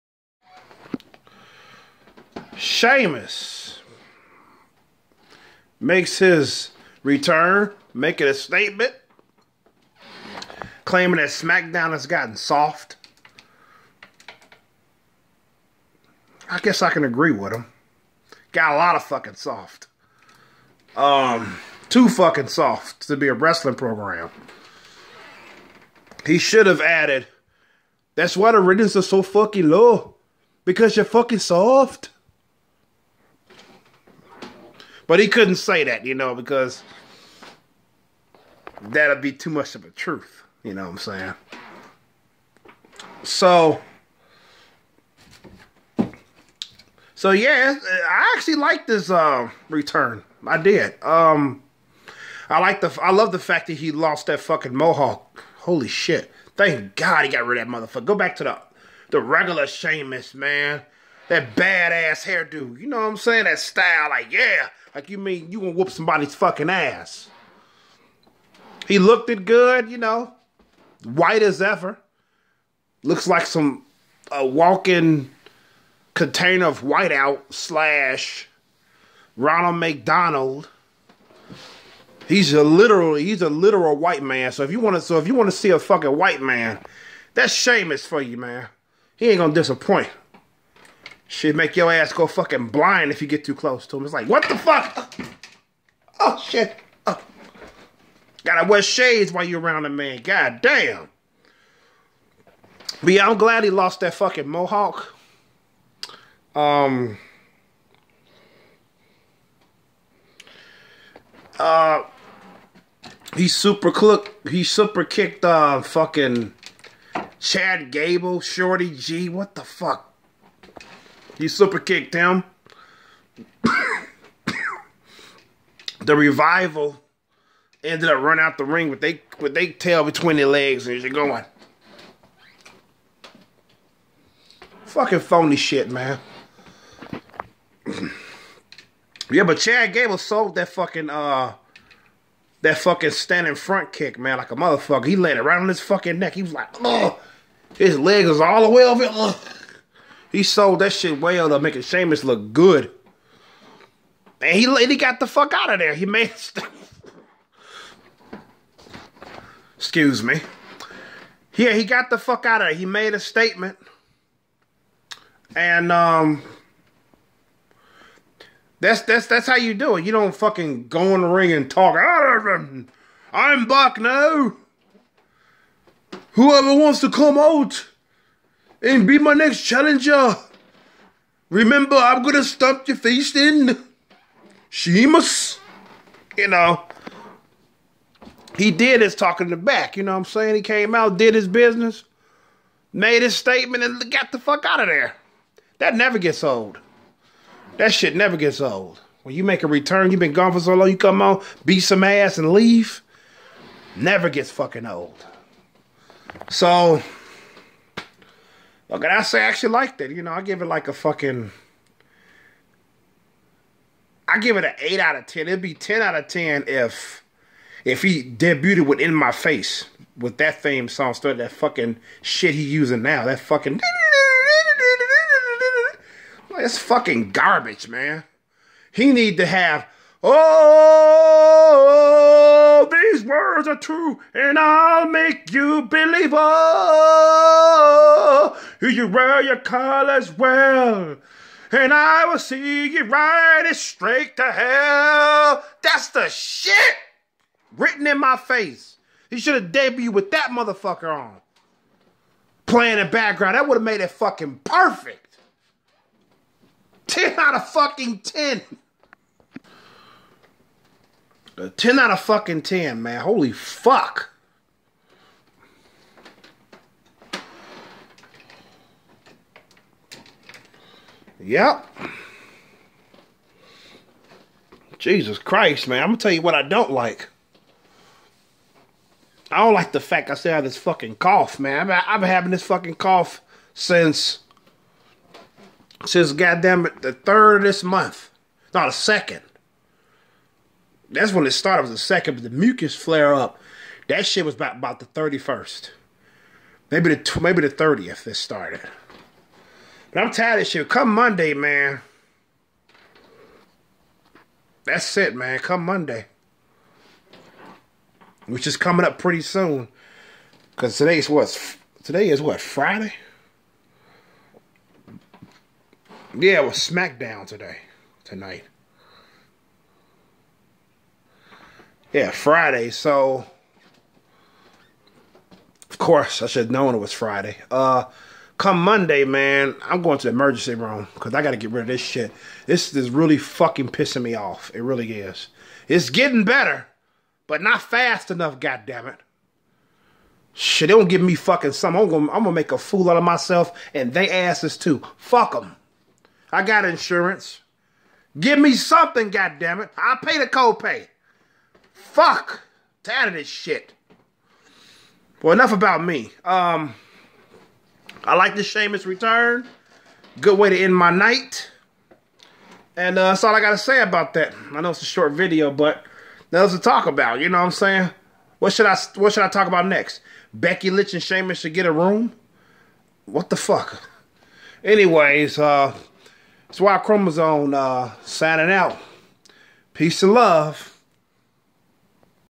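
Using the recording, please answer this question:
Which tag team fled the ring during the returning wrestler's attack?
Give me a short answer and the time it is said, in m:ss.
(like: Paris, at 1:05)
the Revival, at 2:06.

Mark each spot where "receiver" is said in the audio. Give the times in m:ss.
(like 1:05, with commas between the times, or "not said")
not said.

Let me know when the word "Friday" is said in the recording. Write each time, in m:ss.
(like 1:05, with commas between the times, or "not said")
5:12, 5:22, 5:27.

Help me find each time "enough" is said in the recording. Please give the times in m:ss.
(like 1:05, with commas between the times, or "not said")
5:38, 5:55.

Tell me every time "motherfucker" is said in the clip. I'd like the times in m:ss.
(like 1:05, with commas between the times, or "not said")
0:57, 2:24, 4:10.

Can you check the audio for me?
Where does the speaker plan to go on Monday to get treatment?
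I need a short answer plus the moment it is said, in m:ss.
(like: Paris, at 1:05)
emergency room, at 5:30.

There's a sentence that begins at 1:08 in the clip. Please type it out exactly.
He looked it good, you know, white as ever.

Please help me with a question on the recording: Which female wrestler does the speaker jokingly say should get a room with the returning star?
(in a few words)
Becky Lynch.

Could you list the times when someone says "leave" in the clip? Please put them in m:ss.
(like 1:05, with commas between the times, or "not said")
3:22.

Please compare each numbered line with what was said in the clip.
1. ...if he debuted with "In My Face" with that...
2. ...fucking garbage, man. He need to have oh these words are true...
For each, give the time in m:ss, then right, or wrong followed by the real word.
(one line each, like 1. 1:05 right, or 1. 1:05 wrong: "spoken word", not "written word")
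1. 3:37 right
2. 3:46 right.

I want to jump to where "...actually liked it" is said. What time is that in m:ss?
3:29.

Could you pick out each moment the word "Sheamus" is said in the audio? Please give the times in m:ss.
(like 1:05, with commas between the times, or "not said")
0:02, 0:59, 1:27, 2:31, 3:04, 5:58, 6:11.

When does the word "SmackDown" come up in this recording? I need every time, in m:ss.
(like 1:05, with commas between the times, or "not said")
0:11, 5:16.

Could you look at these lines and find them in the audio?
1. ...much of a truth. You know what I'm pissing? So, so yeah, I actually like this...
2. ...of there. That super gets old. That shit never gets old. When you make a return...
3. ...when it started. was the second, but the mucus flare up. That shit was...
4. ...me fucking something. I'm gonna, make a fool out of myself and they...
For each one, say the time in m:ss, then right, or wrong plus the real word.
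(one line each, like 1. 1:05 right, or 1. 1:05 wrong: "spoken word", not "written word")
1. 0:39 wrong: "saying", not "pissing"
2. 3:14 wrong: "never", not "super"
3. 4:51 right
4. 5:41 right.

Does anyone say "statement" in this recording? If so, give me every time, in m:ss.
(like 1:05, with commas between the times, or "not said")
0:08, 2:43, 3:13.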